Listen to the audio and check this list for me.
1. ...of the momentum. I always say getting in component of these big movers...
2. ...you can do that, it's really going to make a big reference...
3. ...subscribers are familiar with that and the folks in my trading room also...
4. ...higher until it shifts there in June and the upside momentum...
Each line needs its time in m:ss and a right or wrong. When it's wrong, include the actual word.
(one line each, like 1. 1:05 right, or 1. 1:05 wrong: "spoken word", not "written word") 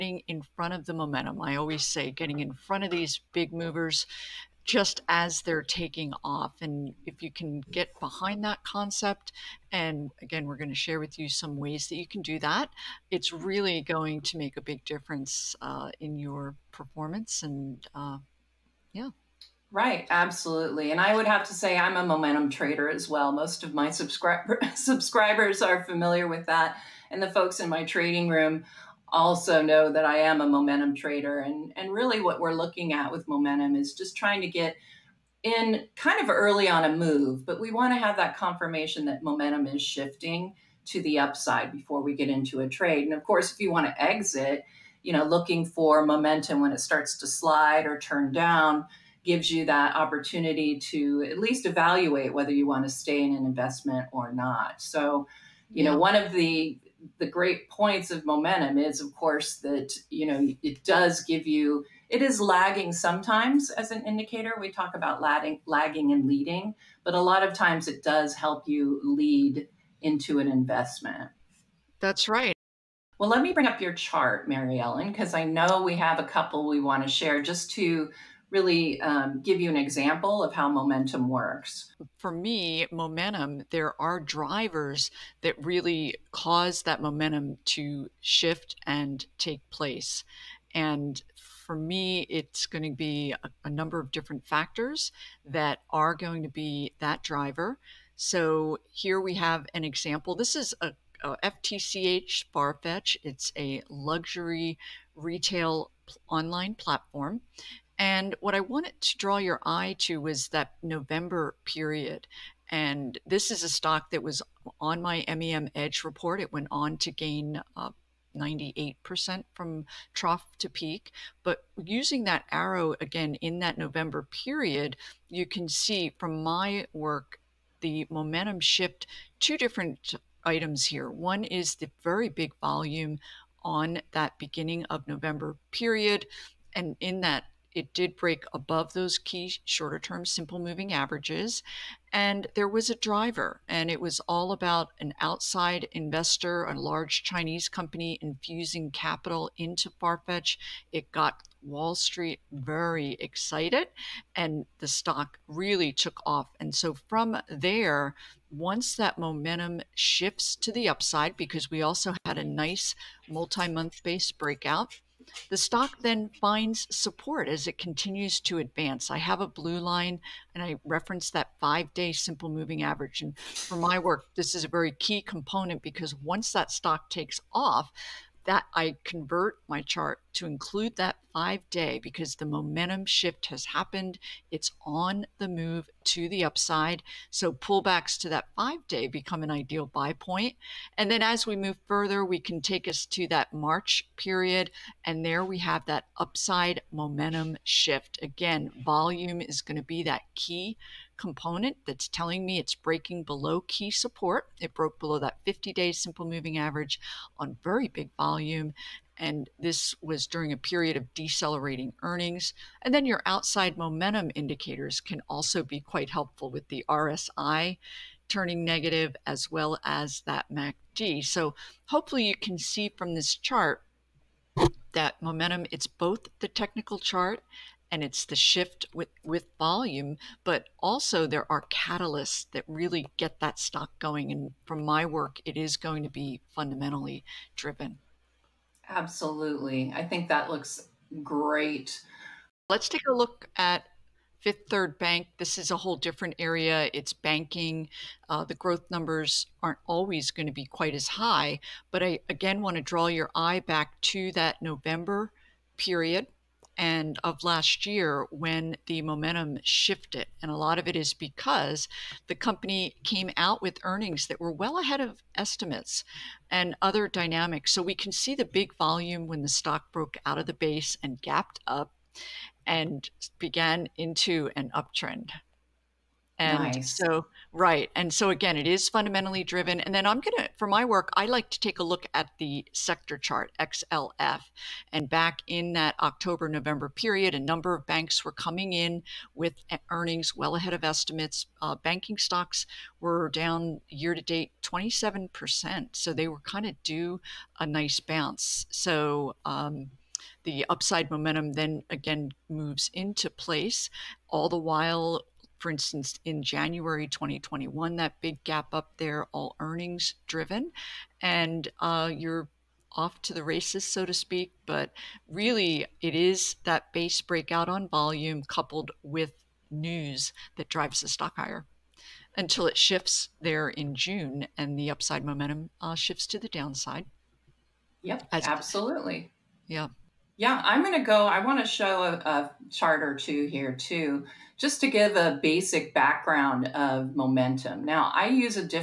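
1. 0:00 wrong: "front", not "component"
2. 0:11 wrong: "difference", not "reference"
3. 0:23 right
4. 5:21 right.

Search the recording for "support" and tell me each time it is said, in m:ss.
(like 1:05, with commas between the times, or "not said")
2:46, 3:23.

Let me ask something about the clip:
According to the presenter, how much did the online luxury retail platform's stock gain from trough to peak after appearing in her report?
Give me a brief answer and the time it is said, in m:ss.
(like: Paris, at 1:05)
98%, at 1:58.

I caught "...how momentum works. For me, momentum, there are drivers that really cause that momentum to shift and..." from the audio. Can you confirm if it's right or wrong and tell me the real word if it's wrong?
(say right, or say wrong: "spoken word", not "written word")
right.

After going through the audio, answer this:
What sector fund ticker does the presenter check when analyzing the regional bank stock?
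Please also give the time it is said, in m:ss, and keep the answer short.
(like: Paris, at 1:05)
XLF, at 4:43.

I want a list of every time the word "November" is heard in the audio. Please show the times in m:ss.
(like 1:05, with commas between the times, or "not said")
1:50, 2:03, 2:15, 4:14, 4:46.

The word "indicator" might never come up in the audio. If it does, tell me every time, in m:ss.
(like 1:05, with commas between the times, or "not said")
1:04, 3:34.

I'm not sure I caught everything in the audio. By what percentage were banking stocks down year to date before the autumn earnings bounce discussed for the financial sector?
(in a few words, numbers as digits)
27%.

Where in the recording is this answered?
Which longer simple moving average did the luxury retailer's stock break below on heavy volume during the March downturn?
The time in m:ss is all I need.
3:25.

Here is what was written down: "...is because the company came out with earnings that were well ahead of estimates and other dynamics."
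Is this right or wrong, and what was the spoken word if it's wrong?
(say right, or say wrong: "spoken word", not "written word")
right.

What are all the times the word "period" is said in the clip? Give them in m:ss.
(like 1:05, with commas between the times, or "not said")
1:51, 2:04, 2:15, 3:14, 3:30, 4:15, 4:46.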